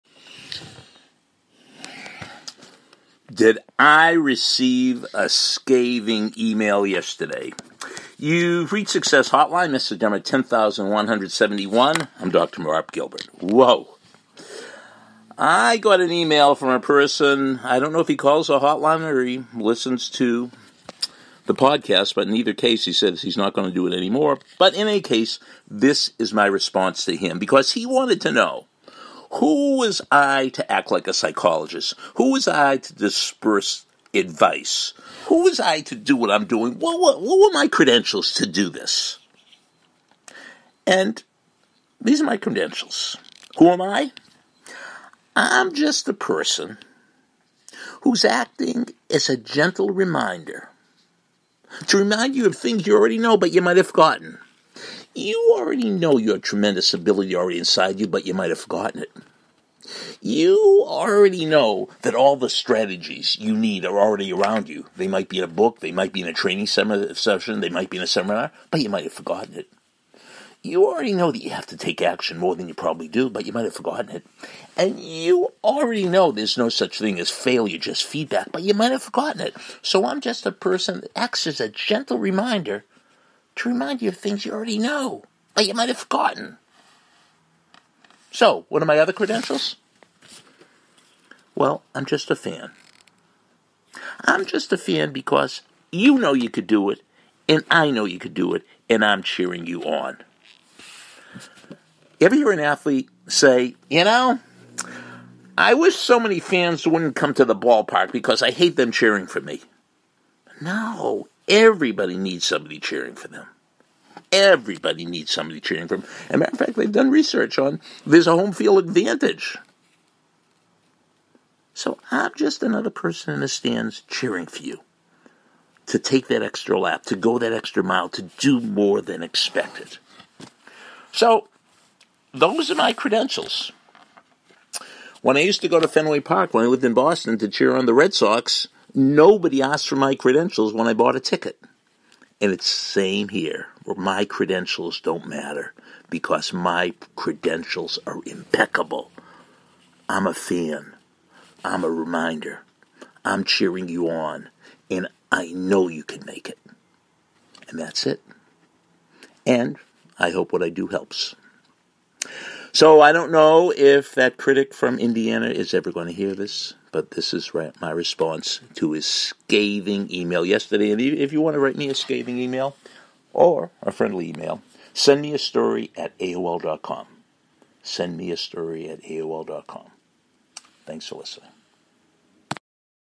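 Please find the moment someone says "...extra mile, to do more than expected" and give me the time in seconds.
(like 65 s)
127 s.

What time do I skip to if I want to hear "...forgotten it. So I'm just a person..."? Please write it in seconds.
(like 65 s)
79 s.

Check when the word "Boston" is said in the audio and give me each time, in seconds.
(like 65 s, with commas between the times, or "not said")
136 s.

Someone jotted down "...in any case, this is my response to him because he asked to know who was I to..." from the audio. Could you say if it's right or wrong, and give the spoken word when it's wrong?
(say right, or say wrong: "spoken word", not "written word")
wrong: "wanted", not "asked".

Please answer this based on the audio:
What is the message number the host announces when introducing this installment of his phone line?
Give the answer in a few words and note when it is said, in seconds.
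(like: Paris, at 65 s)
10171, at 10 s.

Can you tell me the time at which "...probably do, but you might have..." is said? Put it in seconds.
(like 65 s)
72 s.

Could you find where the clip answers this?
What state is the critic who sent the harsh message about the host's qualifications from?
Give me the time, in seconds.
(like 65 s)
164 s.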